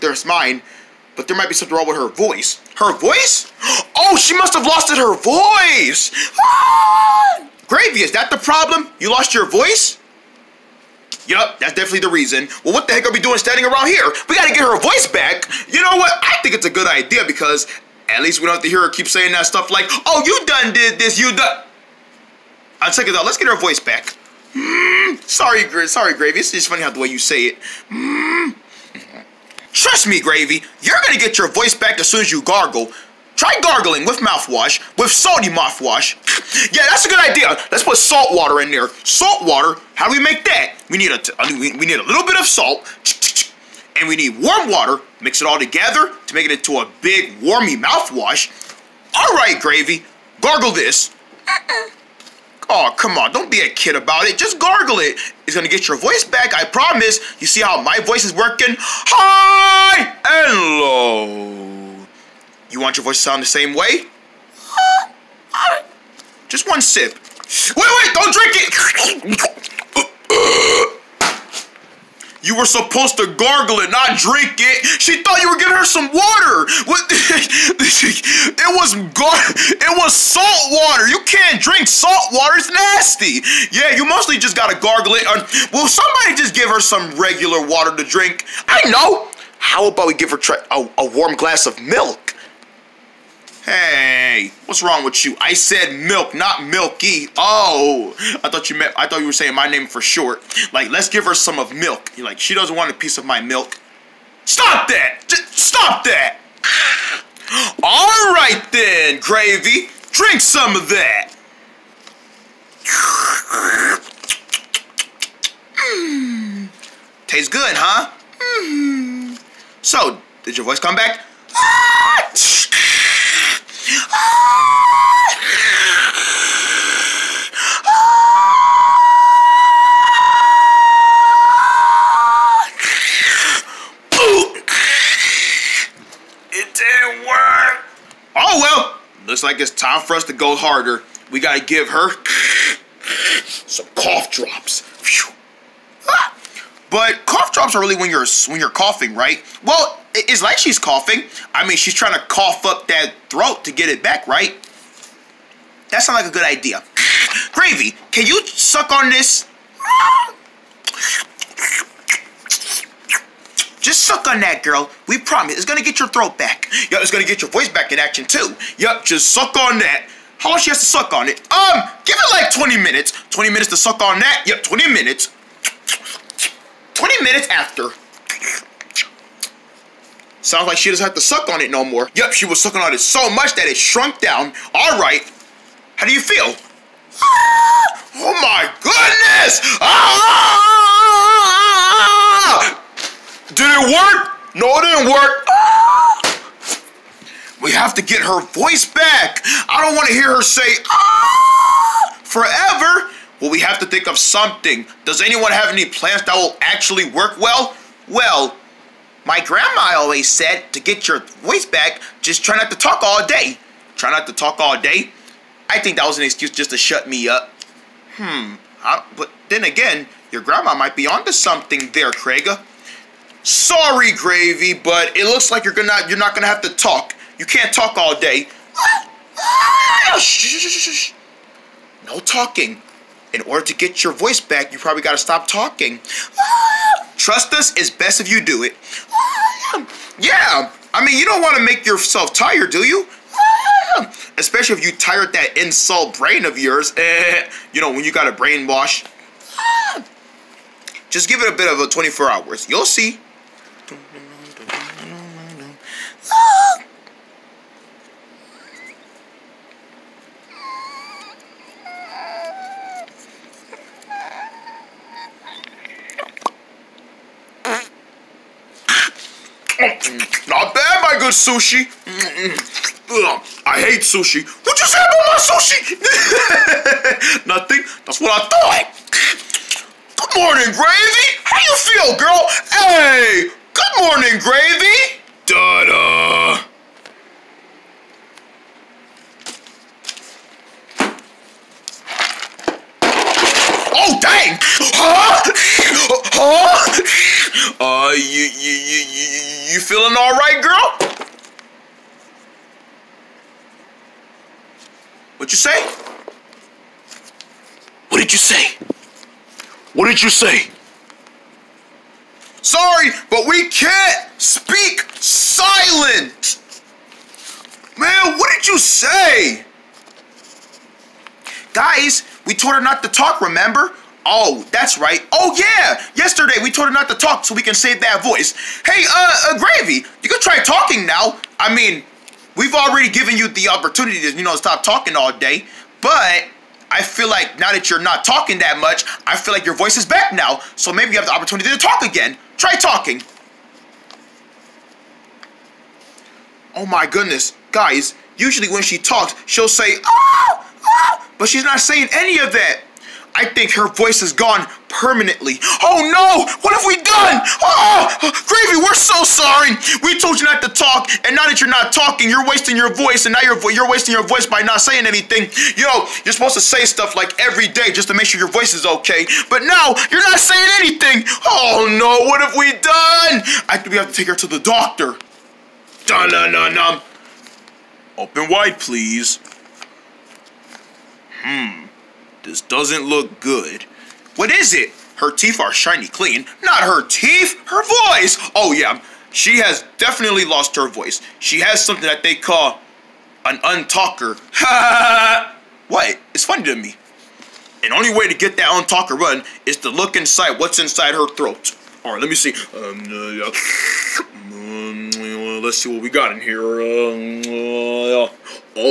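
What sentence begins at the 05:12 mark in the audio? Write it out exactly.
Sorry, but we can't speak silent.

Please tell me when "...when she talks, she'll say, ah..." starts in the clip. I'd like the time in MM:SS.
05:48.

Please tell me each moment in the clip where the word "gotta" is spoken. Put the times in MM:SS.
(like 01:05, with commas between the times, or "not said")
00:14, 01:24, 02:21.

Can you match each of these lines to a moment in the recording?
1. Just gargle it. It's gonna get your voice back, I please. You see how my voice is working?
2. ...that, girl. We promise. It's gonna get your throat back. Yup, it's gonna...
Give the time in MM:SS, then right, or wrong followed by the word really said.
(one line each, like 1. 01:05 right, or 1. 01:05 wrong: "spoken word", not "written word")
1. 00:54 wrong: "promise", not "please"
2. 02:44 right.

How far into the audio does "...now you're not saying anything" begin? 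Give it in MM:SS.
06:09.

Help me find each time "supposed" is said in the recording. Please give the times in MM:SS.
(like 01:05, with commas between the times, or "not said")
01:12, 06:06.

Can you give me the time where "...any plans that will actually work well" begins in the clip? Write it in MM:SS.
03:25.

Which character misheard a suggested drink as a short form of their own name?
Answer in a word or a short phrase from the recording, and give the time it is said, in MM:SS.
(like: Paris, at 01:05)
Milky, at 01:36.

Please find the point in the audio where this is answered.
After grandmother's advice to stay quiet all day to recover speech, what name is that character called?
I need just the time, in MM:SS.
03:42.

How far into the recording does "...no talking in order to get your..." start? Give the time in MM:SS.
03:52.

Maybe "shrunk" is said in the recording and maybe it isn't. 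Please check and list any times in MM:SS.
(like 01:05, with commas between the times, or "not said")
03:03.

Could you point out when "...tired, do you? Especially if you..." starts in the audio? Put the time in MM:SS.
04:02.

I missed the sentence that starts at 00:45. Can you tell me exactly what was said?
Mix it all together to make it into a big, warmy mouthwash.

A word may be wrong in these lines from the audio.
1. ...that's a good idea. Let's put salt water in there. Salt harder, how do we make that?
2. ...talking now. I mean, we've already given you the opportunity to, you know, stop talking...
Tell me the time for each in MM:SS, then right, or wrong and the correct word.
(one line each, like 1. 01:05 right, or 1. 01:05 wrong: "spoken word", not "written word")
1. 00:36 wrong: "water", not "harder"
2. 05:30 right.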